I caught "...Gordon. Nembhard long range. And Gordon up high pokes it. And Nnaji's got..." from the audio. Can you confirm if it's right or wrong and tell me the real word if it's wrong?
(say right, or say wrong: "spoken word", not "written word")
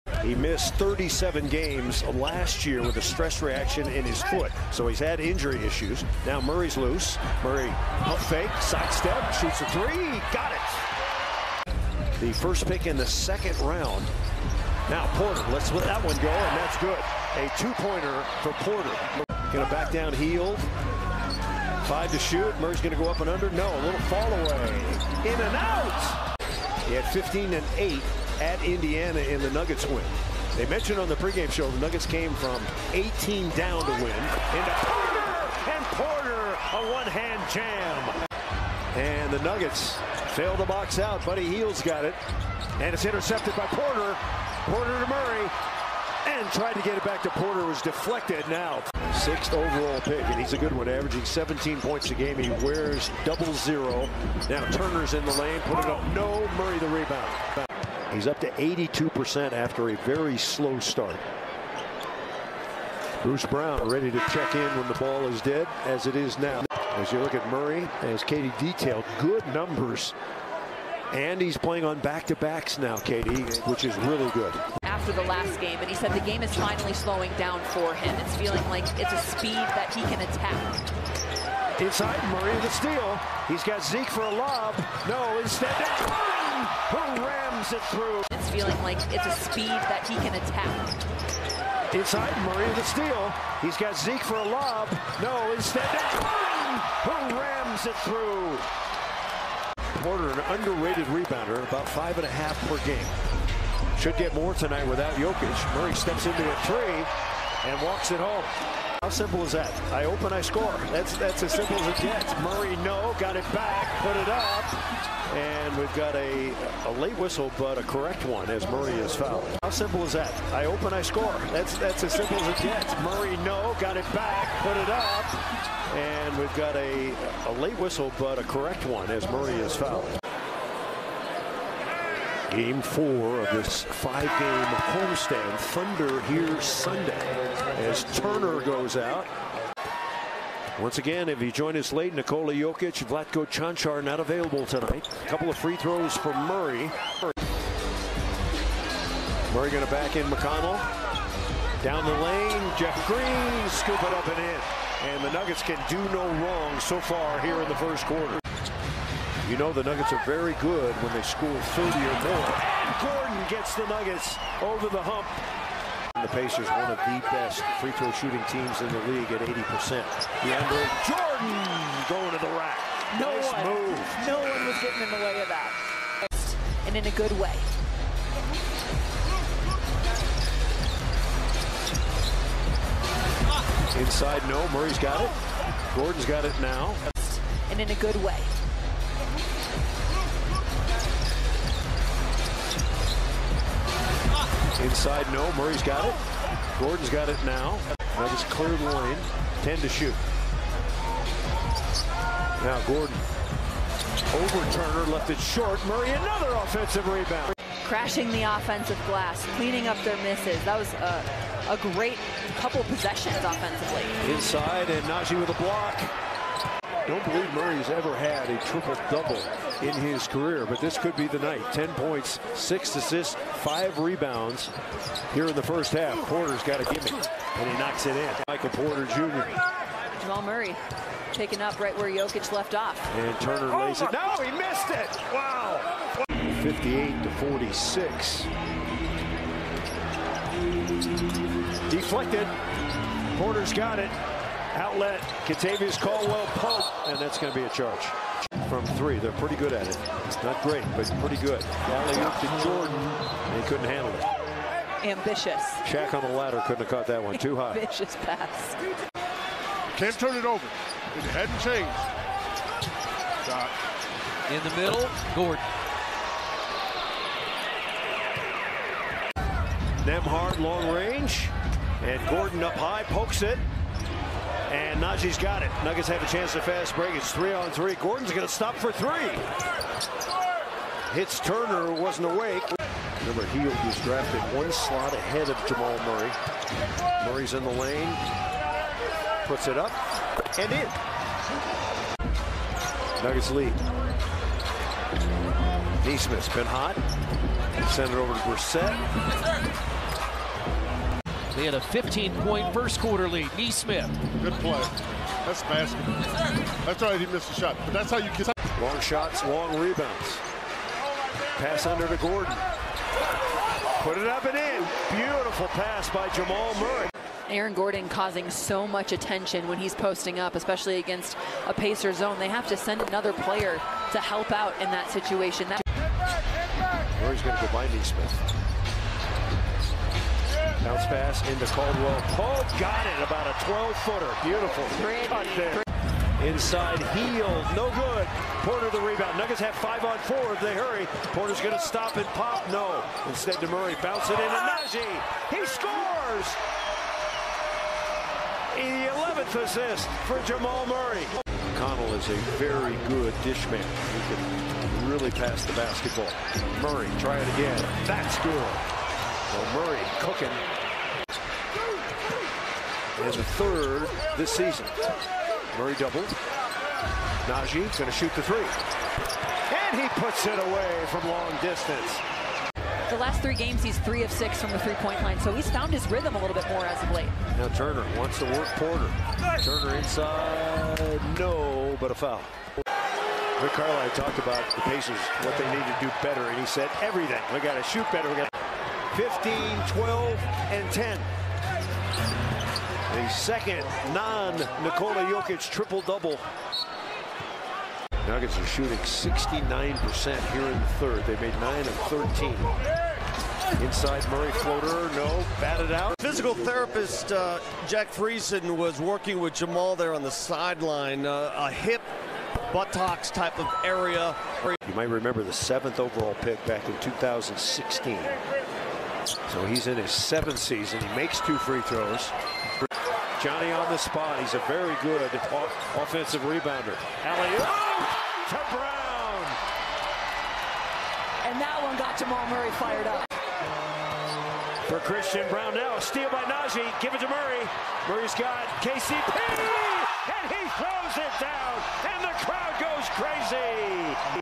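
right.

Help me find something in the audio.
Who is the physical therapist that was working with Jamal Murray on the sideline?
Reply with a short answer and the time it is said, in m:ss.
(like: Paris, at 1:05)
Jack Friesen, at 6:47.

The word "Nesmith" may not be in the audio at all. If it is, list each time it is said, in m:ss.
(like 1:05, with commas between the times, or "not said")
4:56, 5:03, 5:27.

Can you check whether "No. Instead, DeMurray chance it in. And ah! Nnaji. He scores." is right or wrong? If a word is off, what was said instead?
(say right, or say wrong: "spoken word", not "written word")
wrong: "bounce", not "chance".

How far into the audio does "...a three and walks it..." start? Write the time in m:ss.
1:46.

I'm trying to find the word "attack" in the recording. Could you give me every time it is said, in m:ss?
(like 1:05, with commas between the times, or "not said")
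1:20, 1:30.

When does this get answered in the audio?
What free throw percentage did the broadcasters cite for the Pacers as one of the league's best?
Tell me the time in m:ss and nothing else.
2:49.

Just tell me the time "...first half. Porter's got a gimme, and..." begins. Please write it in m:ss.
3:45.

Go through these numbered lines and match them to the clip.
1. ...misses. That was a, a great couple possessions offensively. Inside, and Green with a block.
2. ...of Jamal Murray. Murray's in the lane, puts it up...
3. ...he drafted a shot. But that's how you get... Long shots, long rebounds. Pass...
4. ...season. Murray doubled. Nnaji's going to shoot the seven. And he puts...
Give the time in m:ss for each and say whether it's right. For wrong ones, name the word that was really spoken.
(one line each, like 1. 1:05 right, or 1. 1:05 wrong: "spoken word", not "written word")
1. 3:30 wrong: "Nnaji", not "Green"
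2. 4:45 right
3. 5:07 wrong: "missed", not "drafted"
4. 6:04 wrong: "three", not "seven".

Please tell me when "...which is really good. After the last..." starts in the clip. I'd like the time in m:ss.
1:13.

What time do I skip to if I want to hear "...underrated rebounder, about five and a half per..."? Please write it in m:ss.
1:40.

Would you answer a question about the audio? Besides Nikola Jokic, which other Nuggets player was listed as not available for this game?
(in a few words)
Vlatko Cancar.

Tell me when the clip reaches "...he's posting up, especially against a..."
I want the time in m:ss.
5:19.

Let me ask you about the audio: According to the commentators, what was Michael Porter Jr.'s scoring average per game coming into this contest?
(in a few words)
17 points.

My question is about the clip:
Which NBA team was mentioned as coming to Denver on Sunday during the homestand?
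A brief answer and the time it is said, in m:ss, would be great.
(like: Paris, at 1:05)
Thunder, at 2:15.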